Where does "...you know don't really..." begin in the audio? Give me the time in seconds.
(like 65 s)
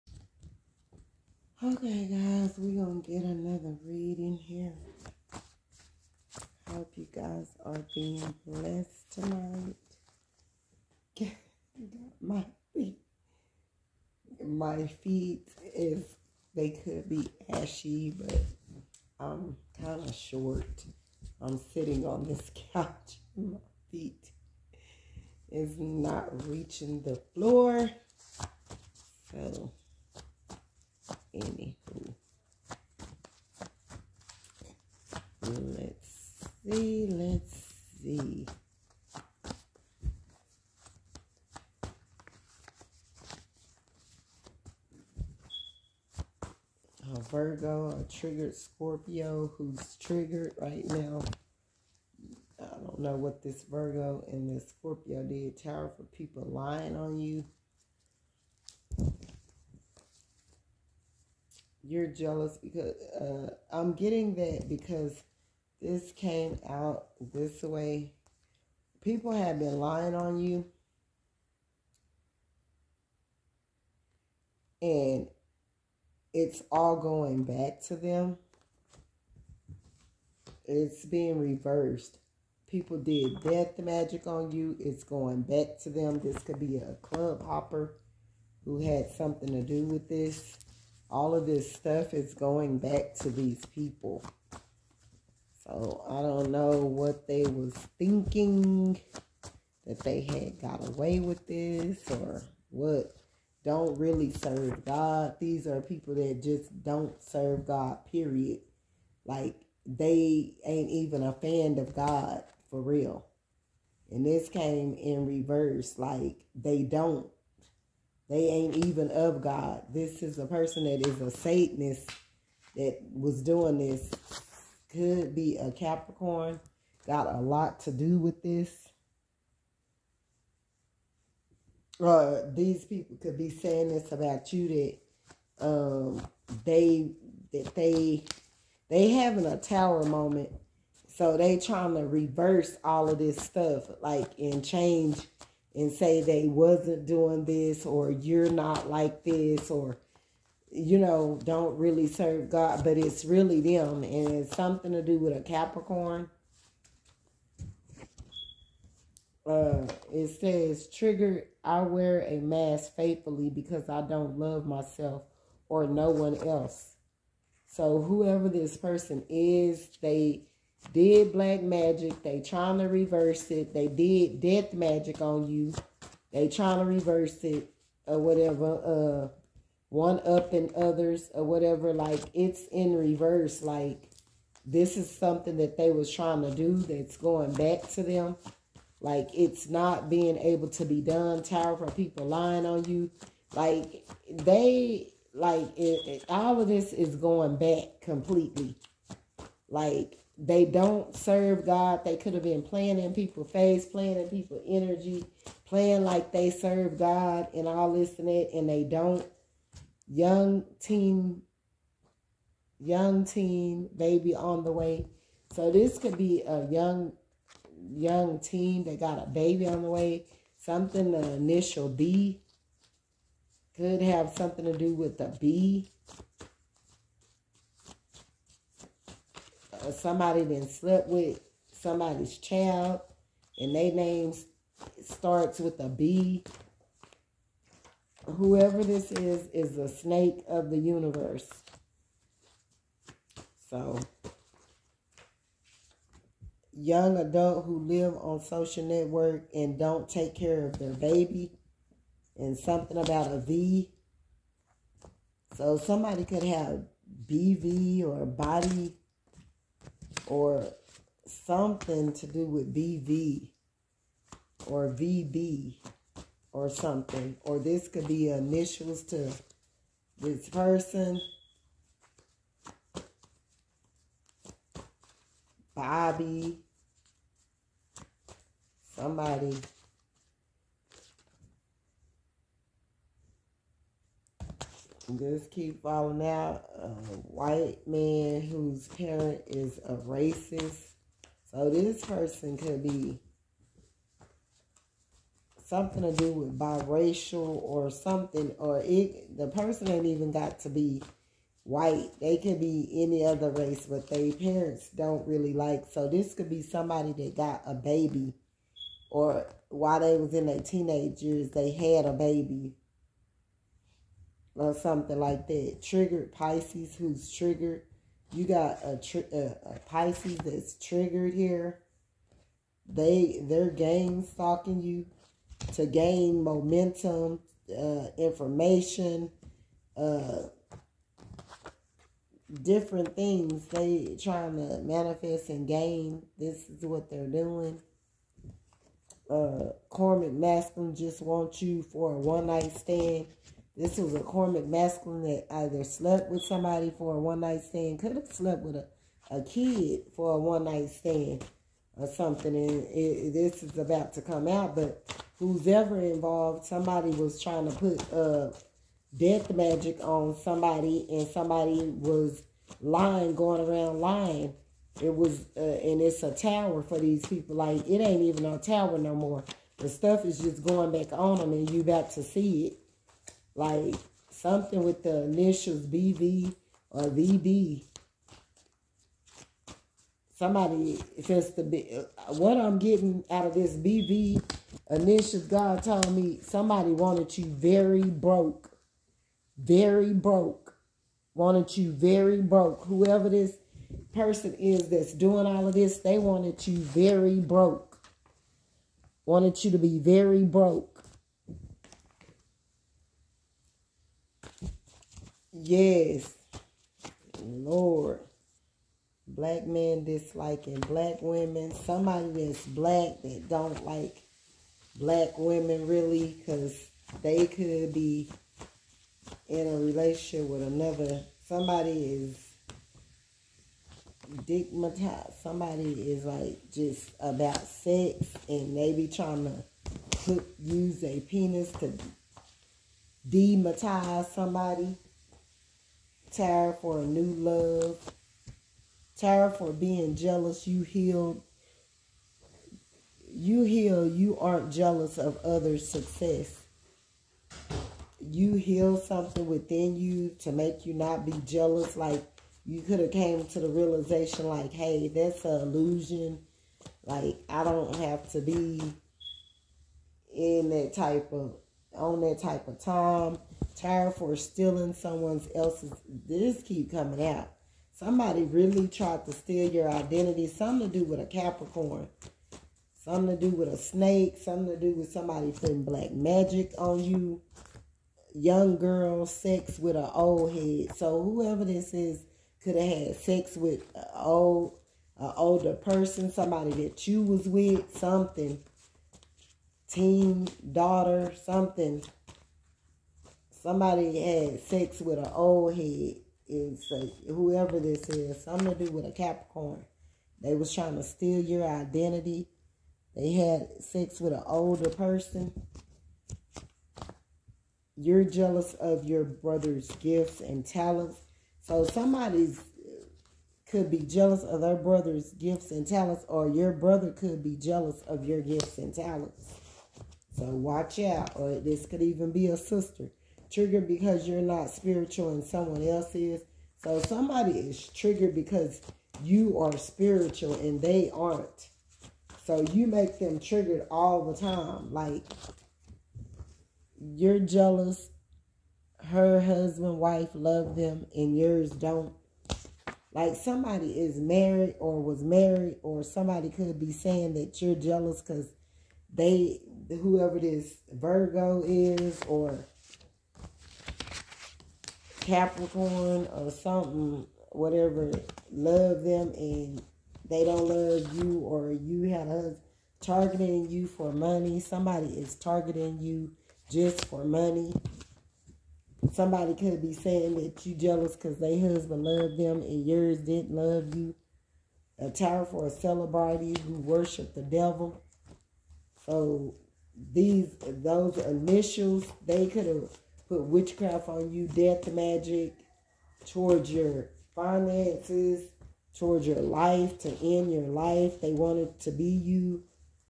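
150 s.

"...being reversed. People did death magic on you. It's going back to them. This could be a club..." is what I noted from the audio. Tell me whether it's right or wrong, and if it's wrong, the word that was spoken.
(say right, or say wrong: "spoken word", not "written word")
right.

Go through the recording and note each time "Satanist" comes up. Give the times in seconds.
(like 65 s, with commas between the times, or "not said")
121 s.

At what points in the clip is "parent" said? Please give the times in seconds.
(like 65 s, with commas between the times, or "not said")
288 s, 304 s.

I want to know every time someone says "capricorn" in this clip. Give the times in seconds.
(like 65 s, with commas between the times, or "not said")
125 s, 155 s, 471 s, 499 s, 555 s.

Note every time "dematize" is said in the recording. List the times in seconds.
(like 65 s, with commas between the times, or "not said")
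433 s.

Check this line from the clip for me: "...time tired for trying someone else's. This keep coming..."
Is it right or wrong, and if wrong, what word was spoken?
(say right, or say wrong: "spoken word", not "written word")
wrong: "stealing", not "trying".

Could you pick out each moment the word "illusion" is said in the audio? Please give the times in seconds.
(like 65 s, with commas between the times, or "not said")
455 s.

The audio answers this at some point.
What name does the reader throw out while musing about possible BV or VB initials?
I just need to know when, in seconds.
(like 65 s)
275 s.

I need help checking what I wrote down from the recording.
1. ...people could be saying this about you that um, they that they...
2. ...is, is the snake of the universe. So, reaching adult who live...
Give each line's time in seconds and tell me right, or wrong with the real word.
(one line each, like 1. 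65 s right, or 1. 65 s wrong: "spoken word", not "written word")
1. 132 s right
2. 239 s wrong: "young", not "reaching".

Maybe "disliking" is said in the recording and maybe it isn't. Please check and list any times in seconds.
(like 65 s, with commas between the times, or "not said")
410 s.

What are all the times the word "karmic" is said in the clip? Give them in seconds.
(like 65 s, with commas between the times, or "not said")
339 s, 344 s.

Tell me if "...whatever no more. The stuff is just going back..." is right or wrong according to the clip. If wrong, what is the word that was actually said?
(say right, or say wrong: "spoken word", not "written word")
wrong: "tower", not "whatever".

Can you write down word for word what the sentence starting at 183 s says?
Like this is something that they was trying to do that's going back to them.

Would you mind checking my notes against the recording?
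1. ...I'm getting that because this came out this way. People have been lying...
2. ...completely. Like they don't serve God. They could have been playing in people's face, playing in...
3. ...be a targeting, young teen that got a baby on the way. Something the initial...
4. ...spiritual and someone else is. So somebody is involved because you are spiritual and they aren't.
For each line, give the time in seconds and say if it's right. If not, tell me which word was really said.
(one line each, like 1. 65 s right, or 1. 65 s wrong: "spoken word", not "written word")
1. 63 s right
2. 198 s right
3. 216 s wrong: "young", not "targeting"
4. 524 s wrong: "triggered", not "involved".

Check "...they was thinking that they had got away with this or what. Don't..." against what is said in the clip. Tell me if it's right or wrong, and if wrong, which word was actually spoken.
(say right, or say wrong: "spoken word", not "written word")
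right.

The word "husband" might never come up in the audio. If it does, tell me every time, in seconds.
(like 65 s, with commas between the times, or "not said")
539 s, 571 s.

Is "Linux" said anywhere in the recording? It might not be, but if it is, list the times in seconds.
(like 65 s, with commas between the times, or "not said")
not said.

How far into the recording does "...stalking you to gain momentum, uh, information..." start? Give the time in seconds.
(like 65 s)
324 s.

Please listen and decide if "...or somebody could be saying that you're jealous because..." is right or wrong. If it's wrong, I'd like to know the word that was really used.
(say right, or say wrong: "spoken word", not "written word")
right.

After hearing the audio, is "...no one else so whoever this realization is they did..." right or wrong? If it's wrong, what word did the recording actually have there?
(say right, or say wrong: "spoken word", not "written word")
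wrong: "person", not "realization".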